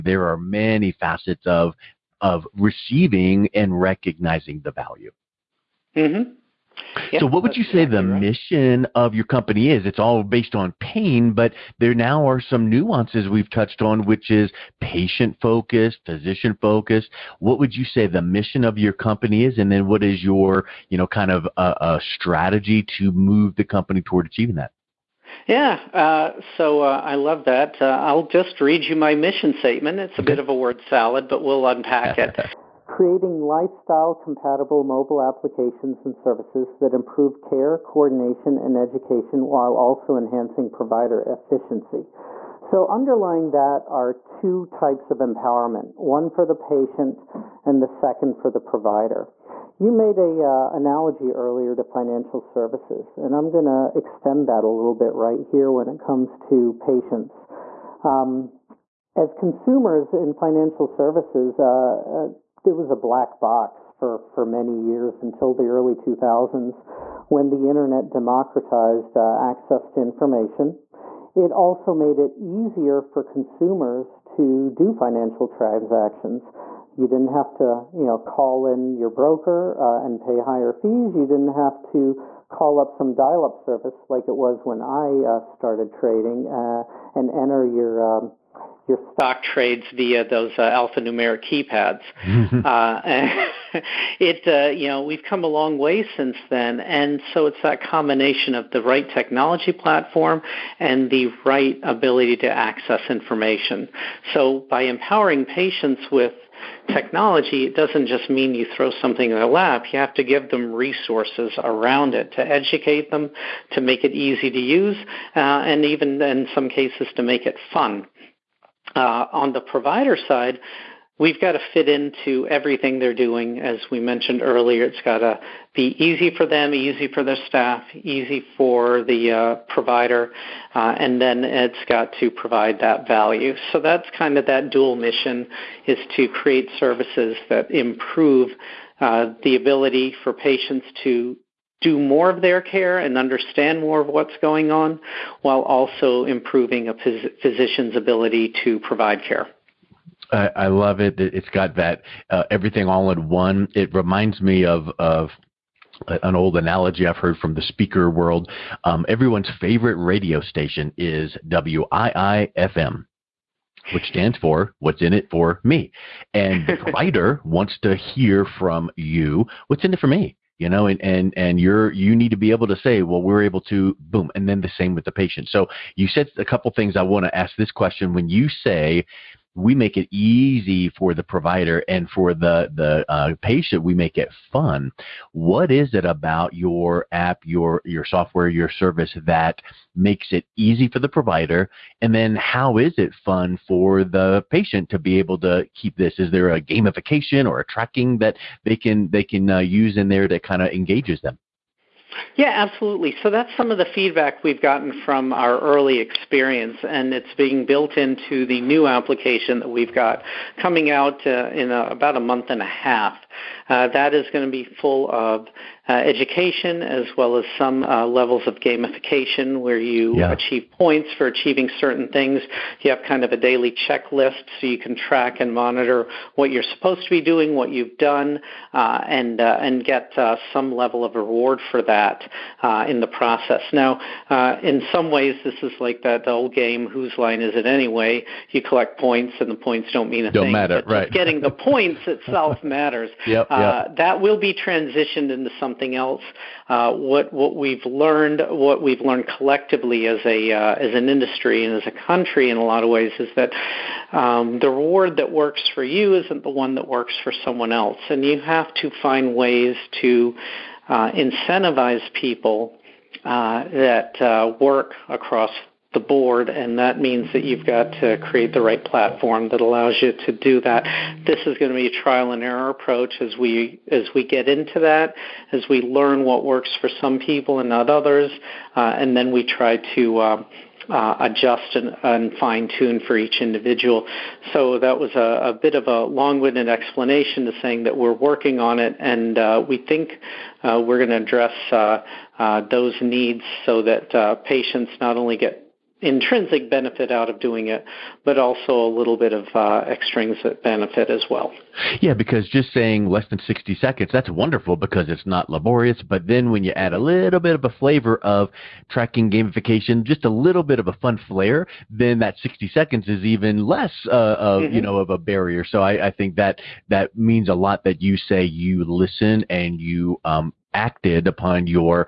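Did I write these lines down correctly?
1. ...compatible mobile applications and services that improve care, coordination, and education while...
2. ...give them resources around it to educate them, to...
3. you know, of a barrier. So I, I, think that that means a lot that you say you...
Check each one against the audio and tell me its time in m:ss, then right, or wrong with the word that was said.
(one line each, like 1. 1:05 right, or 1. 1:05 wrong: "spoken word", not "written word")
1. 0:34 right
2. 1:50 right
3. 5:14 right.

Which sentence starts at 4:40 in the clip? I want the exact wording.
Uh, uh, adjust and, and fine tune for each individual.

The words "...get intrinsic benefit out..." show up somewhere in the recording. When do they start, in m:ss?
4:55.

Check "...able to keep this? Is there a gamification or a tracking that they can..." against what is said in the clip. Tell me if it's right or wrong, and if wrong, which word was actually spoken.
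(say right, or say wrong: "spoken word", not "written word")
right.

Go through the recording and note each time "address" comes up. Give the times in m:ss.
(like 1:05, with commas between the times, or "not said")
4:51.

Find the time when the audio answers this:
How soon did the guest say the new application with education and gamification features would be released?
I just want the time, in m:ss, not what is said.
3:32.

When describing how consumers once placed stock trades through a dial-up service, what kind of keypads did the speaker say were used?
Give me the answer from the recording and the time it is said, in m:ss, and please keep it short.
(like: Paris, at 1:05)
alphanumeric, at 1:30.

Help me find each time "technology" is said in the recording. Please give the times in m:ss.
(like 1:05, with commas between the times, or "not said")
1:39, 1:46.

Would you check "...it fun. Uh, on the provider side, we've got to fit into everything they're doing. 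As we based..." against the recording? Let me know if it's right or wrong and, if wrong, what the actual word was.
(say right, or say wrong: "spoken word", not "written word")
wrong: "mentioned", not "based".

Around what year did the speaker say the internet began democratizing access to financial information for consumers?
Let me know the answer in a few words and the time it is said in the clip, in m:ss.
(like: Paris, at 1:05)
early 2000s, at 1:05.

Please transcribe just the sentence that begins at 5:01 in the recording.
Yeah, because just saying less than 60 seconds, that's wonderful because it's not laborious.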